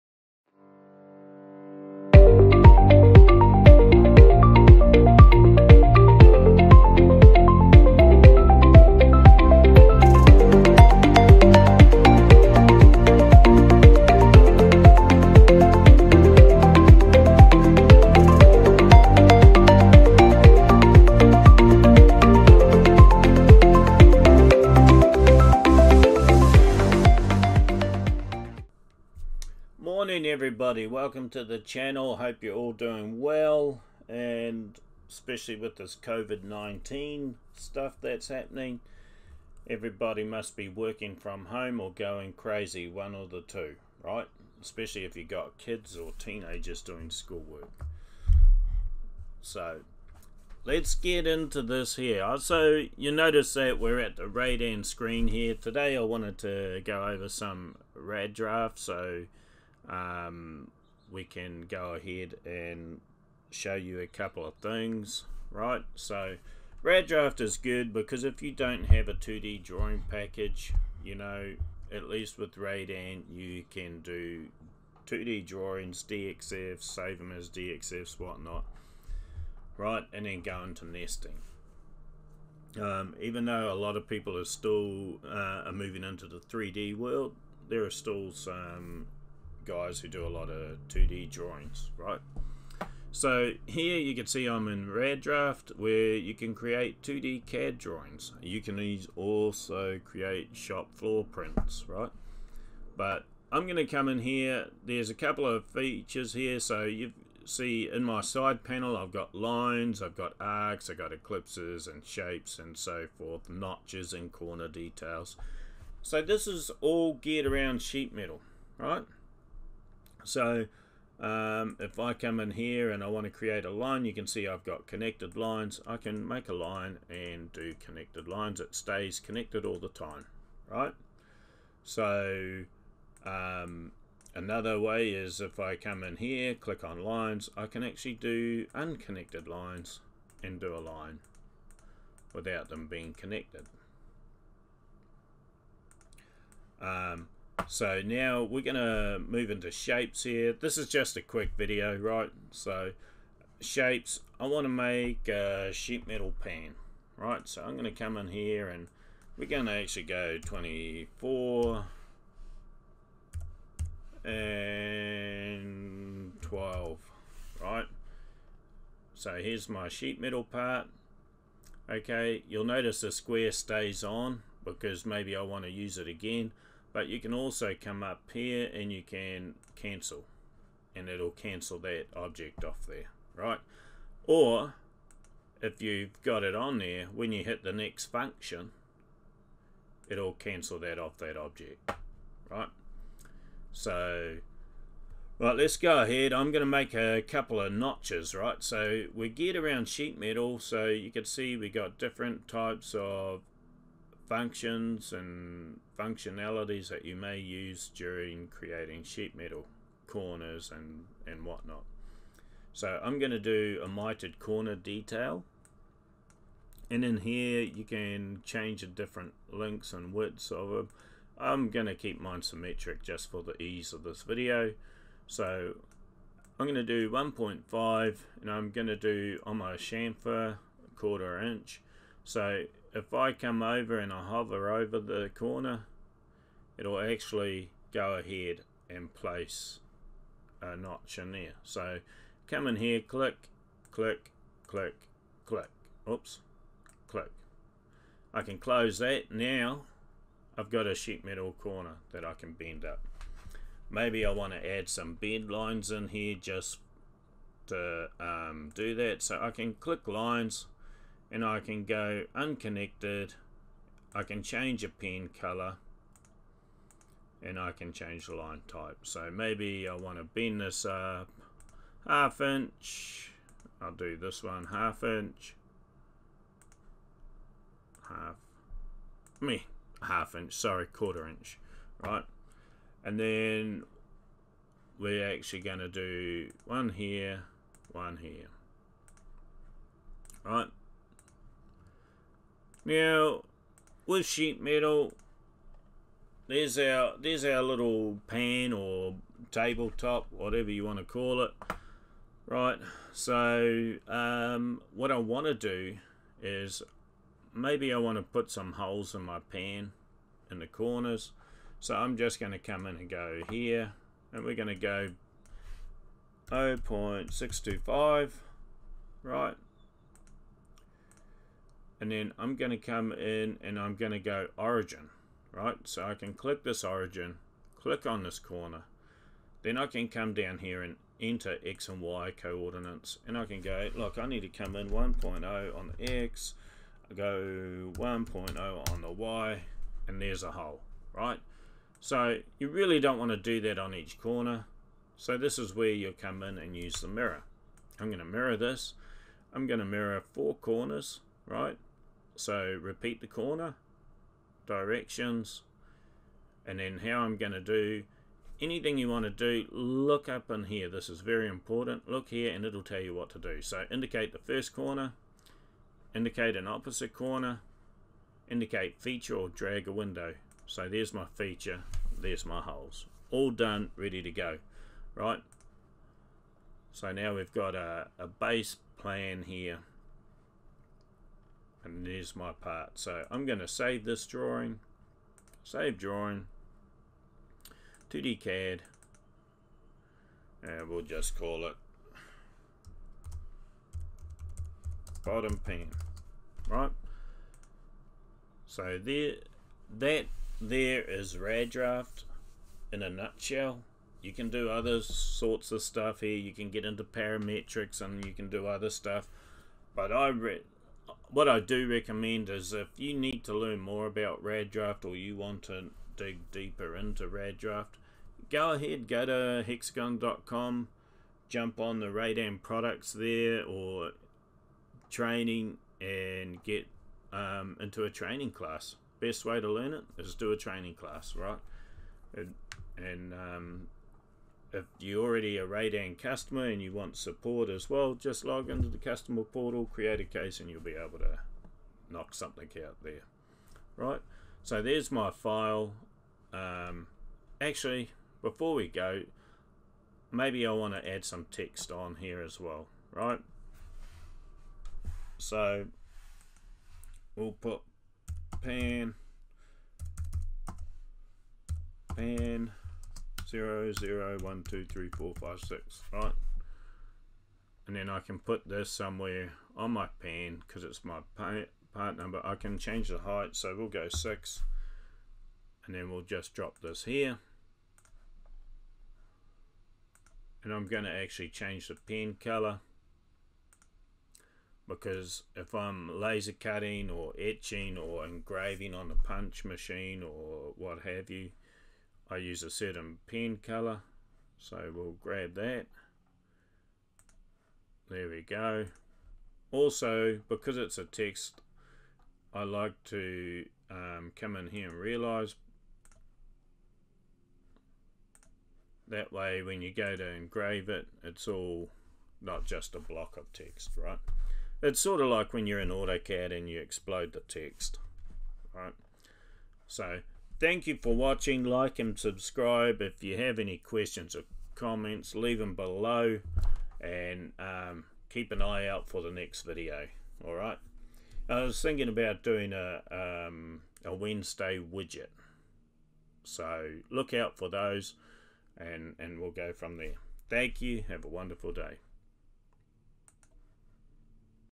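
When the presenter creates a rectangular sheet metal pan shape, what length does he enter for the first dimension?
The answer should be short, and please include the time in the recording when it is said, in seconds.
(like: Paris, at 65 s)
24, at 160 s.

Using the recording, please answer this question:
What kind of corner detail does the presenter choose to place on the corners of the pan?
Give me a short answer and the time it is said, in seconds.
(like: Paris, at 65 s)
mitered corner, at 213 s.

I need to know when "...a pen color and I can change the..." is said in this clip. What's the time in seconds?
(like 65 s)
264 s.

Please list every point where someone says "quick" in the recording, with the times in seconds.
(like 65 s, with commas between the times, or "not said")
151 s.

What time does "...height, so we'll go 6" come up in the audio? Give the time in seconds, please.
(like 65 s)
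473 s.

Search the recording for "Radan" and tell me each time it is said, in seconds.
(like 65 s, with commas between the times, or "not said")
72 s, 422 s, 435 s.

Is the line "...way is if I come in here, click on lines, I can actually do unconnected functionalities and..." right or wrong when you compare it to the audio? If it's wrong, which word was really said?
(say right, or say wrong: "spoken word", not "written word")
wrong: "lines", not "functionalities".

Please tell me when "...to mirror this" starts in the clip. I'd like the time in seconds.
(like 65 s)
348 s.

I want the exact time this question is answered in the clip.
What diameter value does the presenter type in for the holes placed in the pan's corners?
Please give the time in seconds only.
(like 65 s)
316 s.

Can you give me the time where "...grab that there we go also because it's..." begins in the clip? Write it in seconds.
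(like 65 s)
495 s.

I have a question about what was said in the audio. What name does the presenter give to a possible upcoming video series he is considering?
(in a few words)
Wednesday widget.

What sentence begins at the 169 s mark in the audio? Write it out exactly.
So here's my sheet metal part.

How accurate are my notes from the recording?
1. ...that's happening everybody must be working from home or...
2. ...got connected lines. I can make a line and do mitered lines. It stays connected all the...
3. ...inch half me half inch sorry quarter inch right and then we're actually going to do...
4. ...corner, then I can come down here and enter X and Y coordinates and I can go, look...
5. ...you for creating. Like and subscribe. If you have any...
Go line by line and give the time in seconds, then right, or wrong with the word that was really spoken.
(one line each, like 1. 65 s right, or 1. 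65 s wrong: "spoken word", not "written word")
1. 37 s right
2. 124 s wrong: "connected", not "mitered"
3. 275 s right
4. 328 s right
5. 520 s wrong: "watching", not "creating".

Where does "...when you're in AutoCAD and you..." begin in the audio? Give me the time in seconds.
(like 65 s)
515 s.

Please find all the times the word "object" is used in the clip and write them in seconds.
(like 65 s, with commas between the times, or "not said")
182 s, 191 s.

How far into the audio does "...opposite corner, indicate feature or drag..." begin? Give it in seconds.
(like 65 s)
366 s.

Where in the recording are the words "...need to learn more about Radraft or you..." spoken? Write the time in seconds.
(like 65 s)
413 s.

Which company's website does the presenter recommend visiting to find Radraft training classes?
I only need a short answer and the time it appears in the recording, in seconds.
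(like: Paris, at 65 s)
hexagon.com, at 419 s.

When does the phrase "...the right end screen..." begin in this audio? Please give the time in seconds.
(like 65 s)
54 s.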